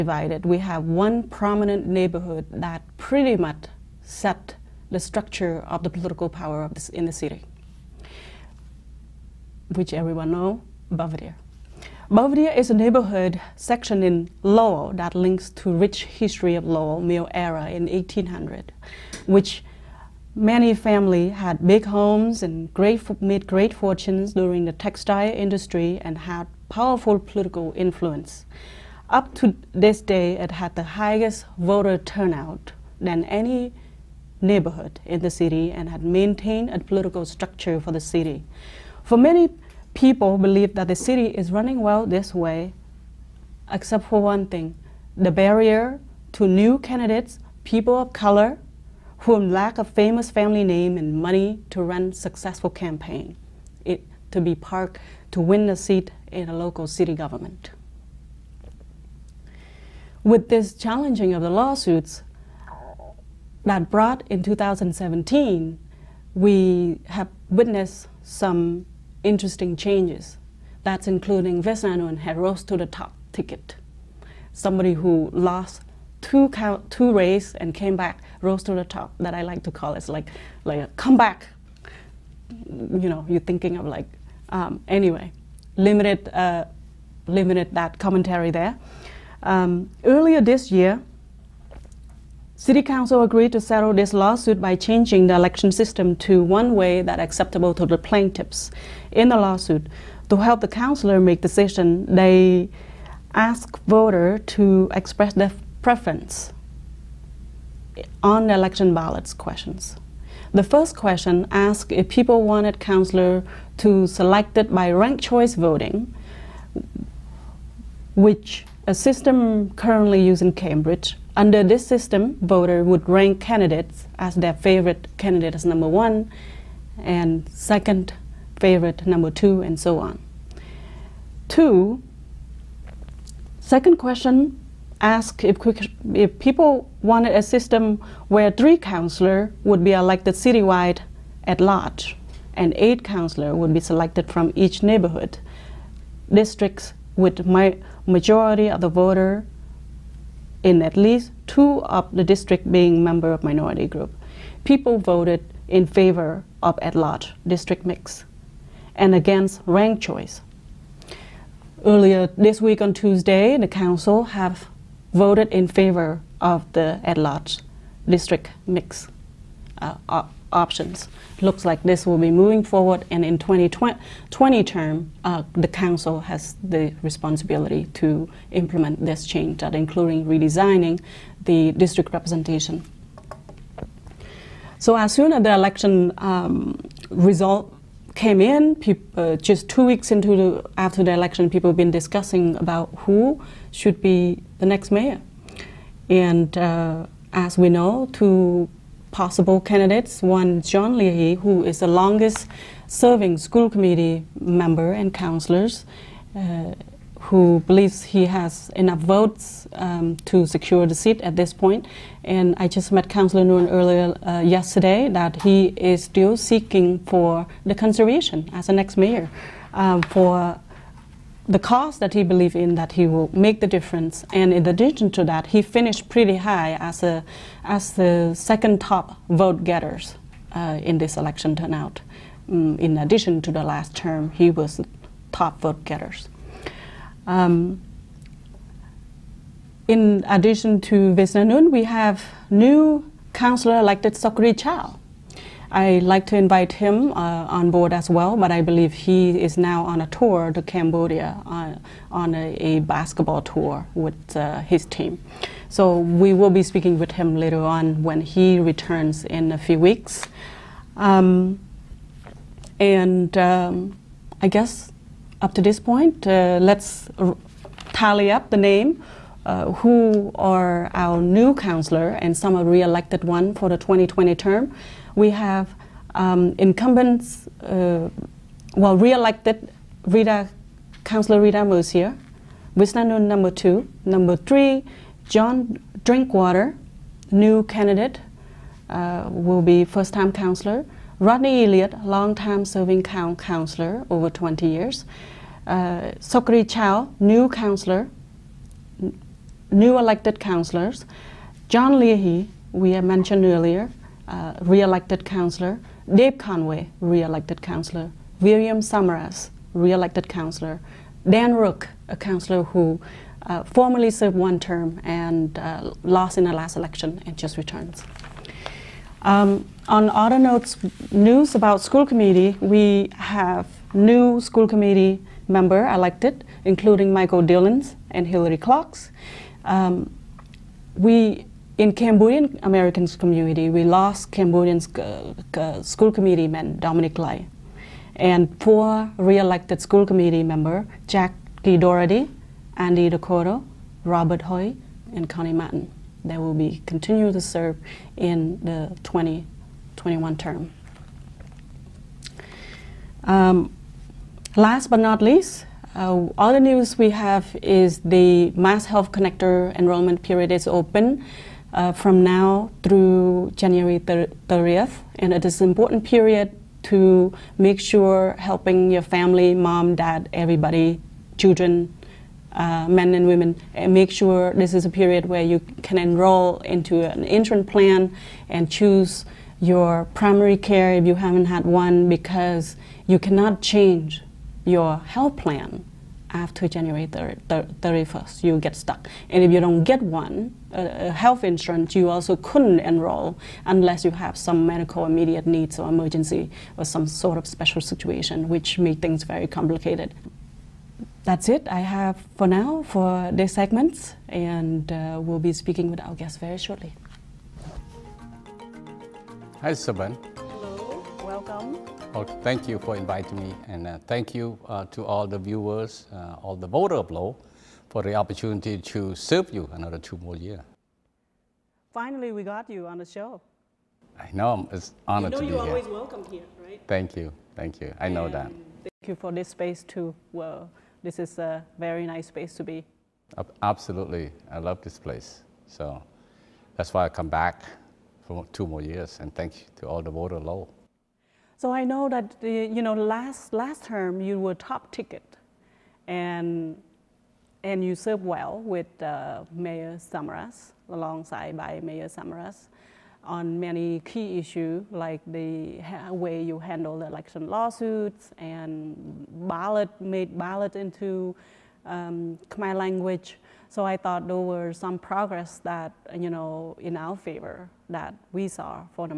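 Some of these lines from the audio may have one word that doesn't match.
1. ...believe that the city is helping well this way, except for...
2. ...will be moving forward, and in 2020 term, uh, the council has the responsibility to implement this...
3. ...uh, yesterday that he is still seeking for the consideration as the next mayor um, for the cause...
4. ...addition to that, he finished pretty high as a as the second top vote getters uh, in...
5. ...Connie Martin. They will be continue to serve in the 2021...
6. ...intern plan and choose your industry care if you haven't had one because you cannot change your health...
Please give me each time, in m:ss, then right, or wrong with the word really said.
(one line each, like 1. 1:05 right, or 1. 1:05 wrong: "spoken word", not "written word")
1. 0:40 wrong: "running", not "helping"
2. 2:52 right
3. 3:34 right
4. 3:44 right
5. 5:45 right
6. 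6:17 wrong: "primary", not "industry".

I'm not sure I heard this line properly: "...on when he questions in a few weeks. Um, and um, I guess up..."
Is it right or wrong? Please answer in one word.
wrong.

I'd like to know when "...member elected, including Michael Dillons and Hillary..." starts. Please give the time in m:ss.
5:25.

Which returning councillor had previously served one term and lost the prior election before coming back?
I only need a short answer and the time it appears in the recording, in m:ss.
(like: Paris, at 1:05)
Dan Rourke, at 5:11.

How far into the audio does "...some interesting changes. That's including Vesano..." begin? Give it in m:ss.
1:08.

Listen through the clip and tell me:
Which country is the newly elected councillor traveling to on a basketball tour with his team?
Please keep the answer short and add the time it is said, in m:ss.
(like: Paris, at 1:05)
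Cambodia, at 4:10.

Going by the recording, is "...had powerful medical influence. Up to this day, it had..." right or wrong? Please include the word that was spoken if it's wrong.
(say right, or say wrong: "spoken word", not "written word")
wrong: "political", not "medical".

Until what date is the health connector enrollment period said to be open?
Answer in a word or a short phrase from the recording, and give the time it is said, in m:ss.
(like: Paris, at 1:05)
January 30th, at 6:03.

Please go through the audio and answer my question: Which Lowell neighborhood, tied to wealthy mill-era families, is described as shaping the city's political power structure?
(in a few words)
Belvedere.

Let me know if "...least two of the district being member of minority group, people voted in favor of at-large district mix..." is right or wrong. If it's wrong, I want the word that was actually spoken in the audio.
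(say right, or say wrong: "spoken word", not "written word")
right.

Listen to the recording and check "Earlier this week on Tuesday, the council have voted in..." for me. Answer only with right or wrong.
right.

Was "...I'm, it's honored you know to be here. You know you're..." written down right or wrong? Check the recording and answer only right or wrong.
right.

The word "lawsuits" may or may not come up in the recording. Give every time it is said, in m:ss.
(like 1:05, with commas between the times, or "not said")
1:01, 1:34, 1:39, 7:37.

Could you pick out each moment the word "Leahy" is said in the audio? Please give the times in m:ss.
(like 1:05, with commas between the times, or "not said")
3:20, 5:01.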